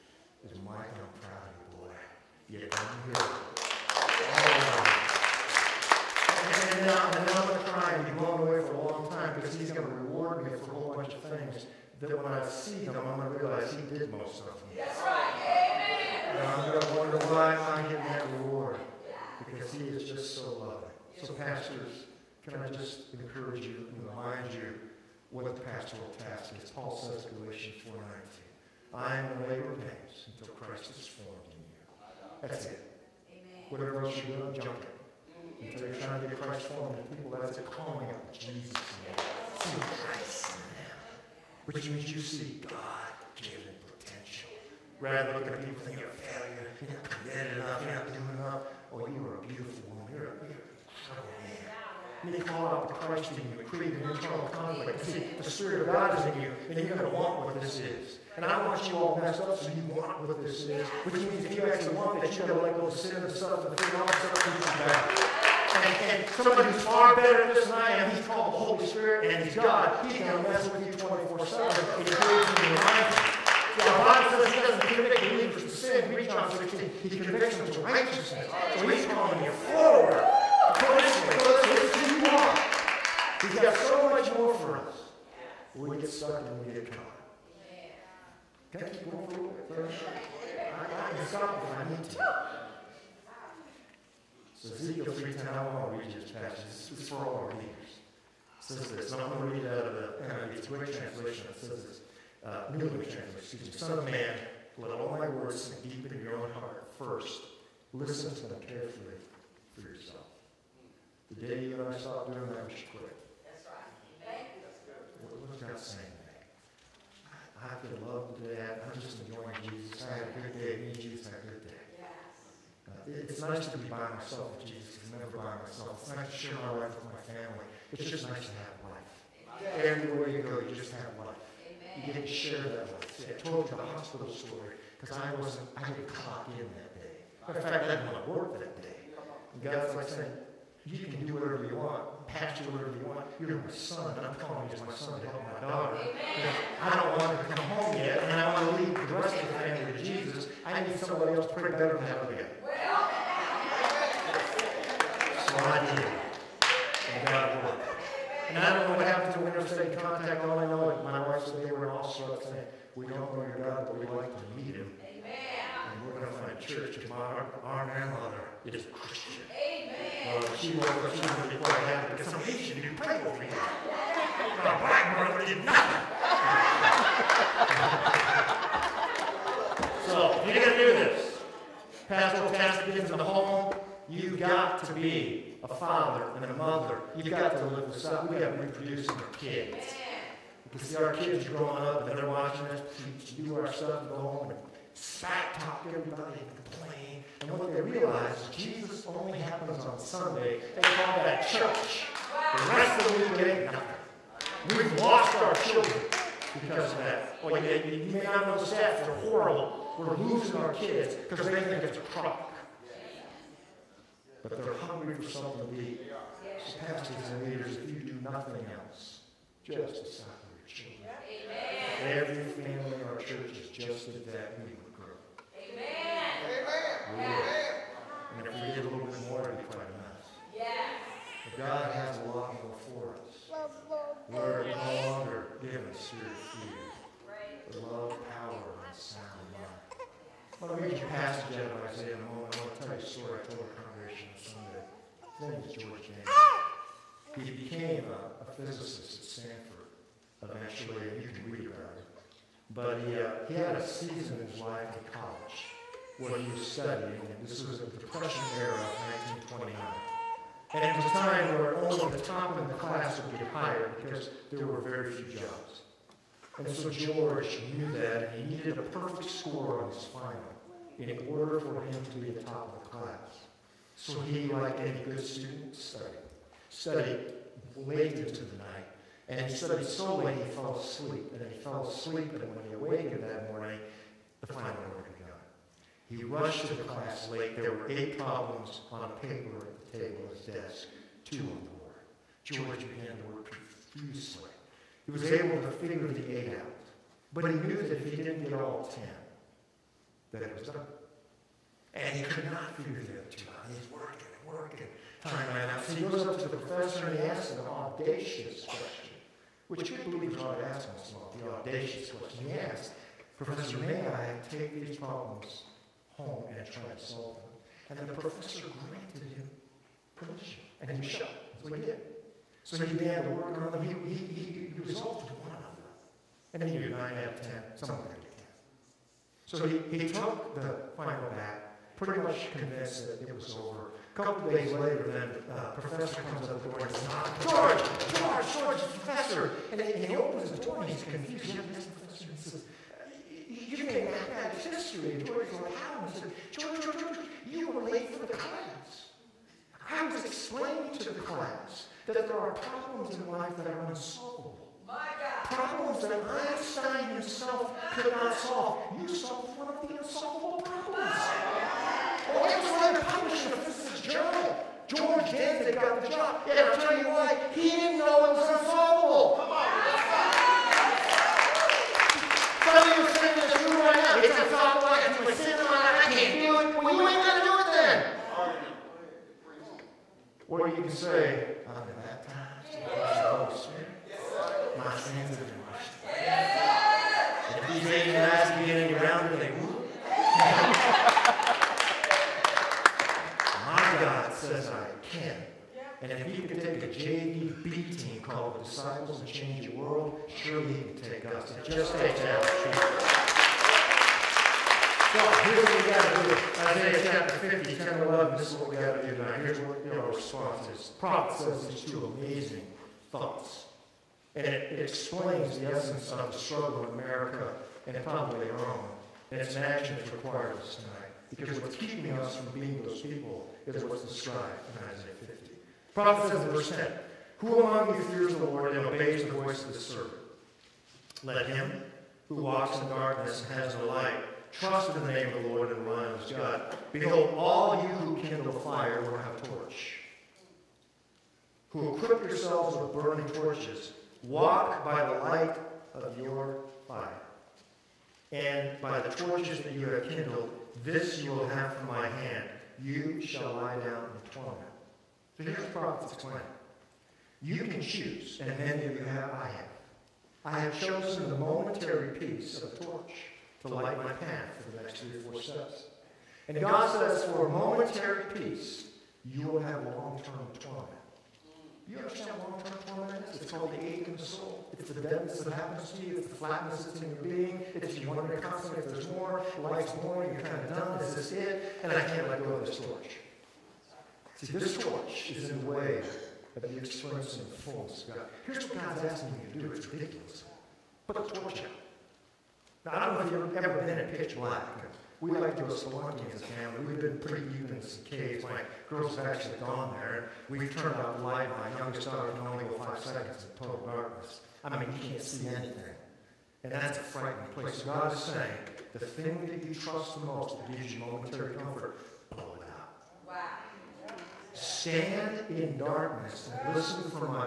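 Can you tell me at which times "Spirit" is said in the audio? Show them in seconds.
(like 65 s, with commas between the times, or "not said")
55 s, 68 s, 383 s.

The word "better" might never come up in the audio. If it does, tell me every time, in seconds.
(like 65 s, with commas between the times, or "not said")
67 s, 151 s.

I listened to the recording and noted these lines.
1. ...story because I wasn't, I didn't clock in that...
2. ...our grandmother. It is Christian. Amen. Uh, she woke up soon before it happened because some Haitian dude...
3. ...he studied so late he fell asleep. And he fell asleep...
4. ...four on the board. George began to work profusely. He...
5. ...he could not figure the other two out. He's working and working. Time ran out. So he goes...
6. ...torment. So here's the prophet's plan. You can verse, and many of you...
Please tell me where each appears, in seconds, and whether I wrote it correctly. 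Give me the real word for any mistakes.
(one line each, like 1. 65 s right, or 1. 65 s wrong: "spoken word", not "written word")
1. 134 s right
2. 167 s right
3. 279 s right
4. 291 s wrong: "two", not "four"
5. 302 s right
6. 454 s wrong: "choose", not "verse".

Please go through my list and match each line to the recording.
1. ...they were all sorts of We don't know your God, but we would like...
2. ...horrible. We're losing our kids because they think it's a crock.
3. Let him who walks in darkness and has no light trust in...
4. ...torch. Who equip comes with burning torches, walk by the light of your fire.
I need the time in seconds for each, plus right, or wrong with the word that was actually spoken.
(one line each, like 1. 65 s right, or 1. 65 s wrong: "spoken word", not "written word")
1. 161 s right
2. 209 s right
3. 431 s right
4. 439 s wrong: "yourselves", not "comes".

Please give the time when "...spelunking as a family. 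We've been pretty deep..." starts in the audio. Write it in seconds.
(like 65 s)
495 s.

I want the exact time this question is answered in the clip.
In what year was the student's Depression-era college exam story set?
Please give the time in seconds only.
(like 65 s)
259 s.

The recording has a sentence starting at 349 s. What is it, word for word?
I was explaining to the class that there are problems in life that are unsolvable.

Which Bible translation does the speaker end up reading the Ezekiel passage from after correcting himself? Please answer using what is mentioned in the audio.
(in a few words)
New Living Translation.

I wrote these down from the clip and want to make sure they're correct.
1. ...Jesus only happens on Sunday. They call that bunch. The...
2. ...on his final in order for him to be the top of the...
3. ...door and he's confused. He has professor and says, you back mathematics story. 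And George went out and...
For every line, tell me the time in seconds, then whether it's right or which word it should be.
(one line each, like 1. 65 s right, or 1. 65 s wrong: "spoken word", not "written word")
1. 198 s wrong: "church", not "bunch"
2. 269 s right
3. 340 s wrong: "history", not "story".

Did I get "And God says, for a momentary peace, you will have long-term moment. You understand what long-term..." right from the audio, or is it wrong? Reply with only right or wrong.
wrong.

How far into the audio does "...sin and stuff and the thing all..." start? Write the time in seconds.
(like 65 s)
62 s.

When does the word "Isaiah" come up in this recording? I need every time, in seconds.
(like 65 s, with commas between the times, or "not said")
241 s, 406 s, 424 s.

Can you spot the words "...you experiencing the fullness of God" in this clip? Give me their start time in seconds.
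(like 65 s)
486 s.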